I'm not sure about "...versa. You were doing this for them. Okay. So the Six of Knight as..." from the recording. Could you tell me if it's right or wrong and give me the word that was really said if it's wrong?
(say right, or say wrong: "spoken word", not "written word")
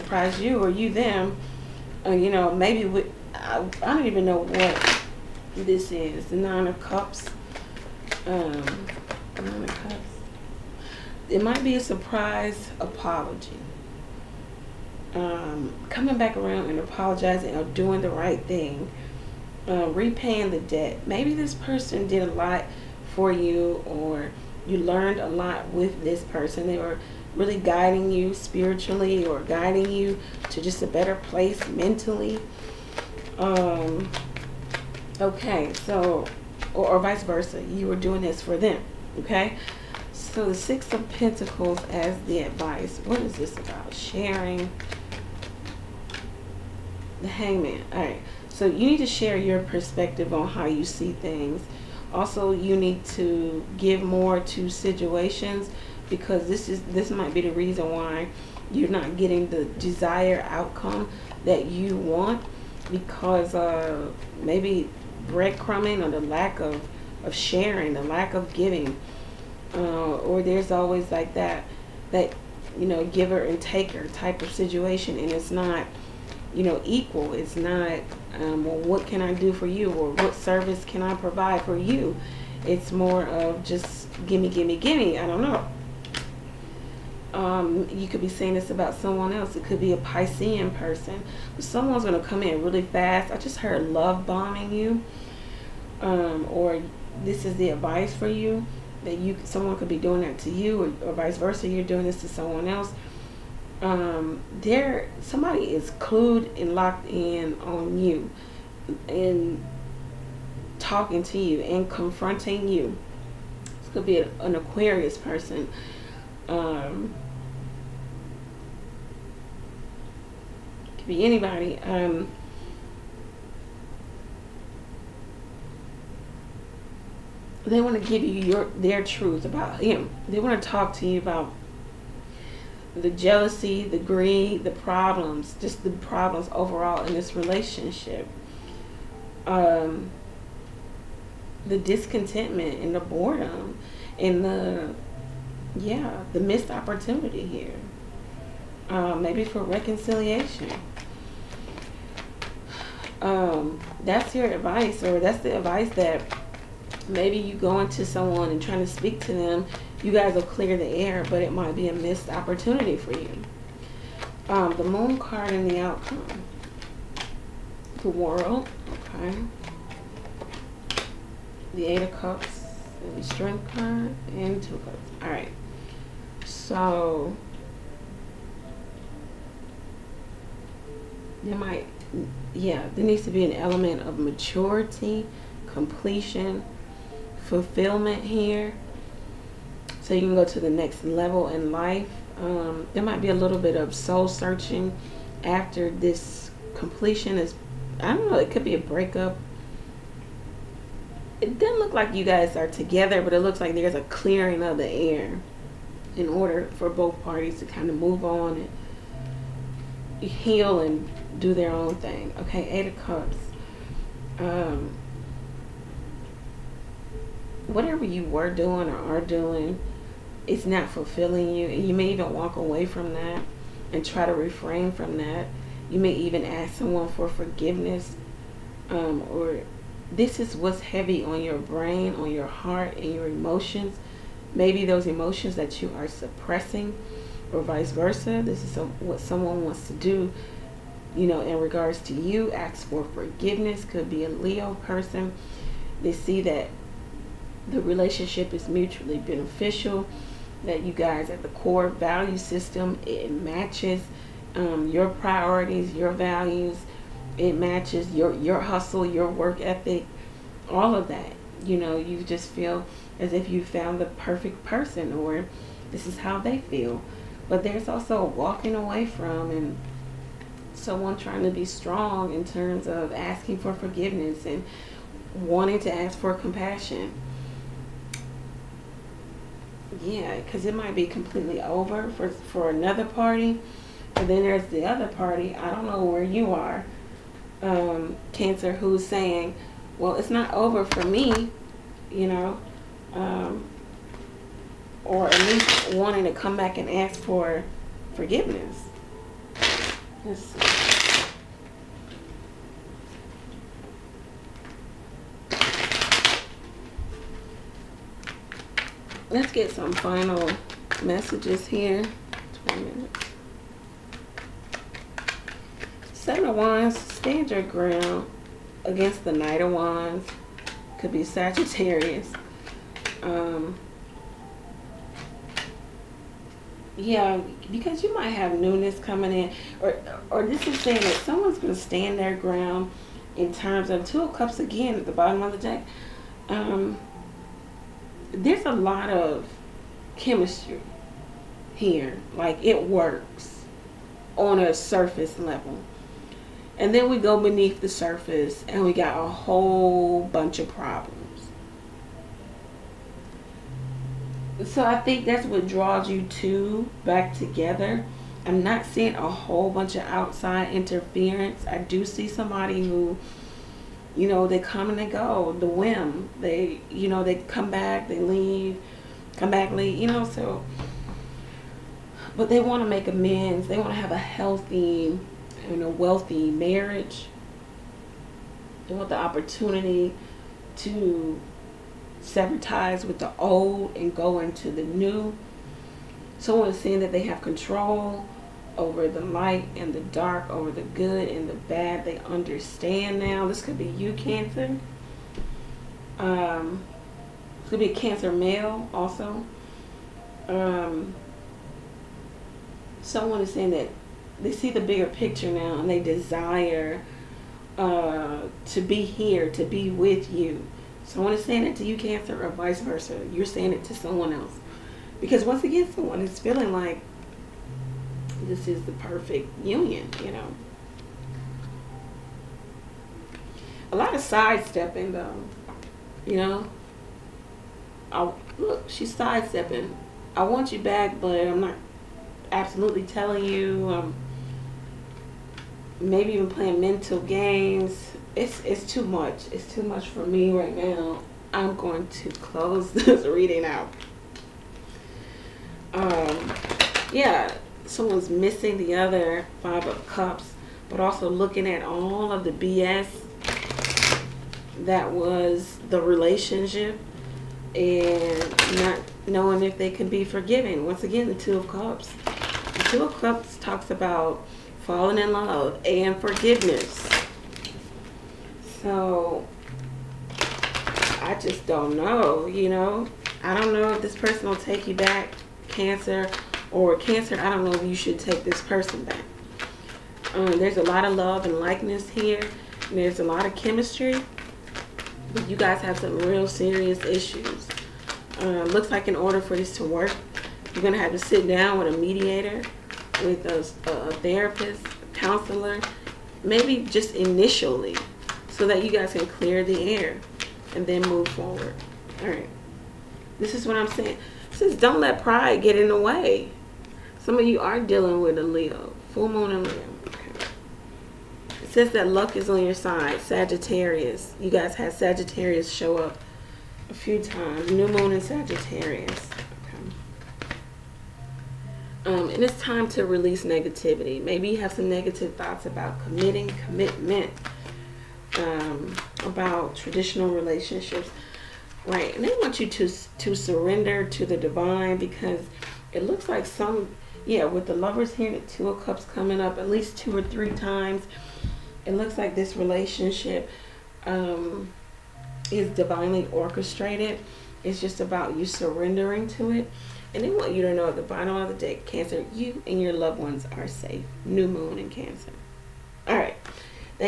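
wrong: "Pentacles", not "Knight".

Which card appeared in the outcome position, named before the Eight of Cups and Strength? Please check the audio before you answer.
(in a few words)
The World.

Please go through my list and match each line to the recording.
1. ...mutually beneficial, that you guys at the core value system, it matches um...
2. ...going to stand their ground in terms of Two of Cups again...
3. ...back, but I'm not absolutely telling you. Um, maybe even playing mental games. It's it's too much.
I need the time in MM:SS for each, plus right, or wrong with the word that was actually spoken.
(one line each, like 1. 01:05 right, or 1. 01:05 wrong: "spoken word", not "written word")
1. 04:08 right
2. 05:31 right
3. 07:10 right.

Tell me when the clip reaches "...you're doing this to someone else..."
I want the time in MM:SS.
01:41.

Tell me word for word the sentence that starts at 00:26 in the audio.
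They were really guiding you spiritually or guiding you to just a better place mentally.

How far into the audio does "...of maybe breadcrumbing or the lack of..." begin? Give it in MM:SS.
01:03.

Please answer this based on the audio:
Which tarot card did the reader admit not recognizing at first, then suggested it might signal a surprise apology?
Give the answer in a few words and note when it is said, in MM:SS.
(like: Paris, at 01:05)
Nine of Cups, at 00:06.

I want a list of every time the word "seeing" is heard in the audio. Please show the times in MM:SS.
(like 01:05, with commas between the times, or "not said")
05:58, 06:26.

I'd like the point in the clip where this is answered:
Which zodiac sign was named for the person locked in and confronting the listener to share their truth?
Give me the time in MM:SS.
01:54.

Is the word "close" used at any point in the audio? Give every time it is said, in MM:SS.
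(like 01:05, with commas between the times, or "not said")
07:22.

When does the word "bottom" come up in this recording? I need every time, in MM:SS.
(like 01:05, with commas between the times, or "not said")
05:35, 09:11.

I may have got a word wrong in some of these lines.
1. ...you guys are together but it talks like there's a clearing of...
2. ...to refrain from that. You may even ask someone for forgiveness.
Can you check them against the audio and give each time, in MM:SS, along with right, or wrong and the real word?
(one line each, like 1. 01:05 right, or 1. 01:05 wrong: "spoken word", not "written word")
1. 03:22 wrong: "looks", not "talks"
2. 03:44 right.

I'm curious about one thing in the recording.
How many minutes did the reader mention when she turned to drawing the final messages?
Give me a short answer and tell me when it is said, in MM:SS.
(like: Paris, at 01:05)
20, at 05:12.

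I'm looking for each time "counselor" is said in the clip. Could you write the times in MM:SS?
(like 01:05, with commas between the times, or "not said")
08:15.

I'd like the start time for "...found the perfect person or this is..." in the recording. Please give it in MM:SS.
04:23.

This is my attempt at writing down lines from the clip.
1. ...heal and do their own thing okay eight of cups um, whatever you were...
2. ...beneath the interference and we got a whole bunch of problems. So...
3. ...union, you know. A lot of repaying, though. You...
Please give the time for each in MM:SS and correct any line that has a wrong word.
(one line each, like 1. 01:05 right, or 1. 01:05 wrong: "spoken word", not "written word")
1. 03:30 right
2. 05:47 wrong: "surface", not "interference"
3. 06:59 wrong: "sidestepping", not "repaying".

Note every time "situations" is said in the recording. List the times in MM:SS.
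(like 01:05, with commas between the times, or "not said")
00:54, 01:14.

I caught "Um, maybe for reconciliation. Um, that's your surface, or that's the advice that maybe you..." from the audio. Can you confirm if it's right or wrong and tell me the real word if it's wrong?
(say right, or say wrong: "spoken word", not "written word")
wrong: "advice", not "surface".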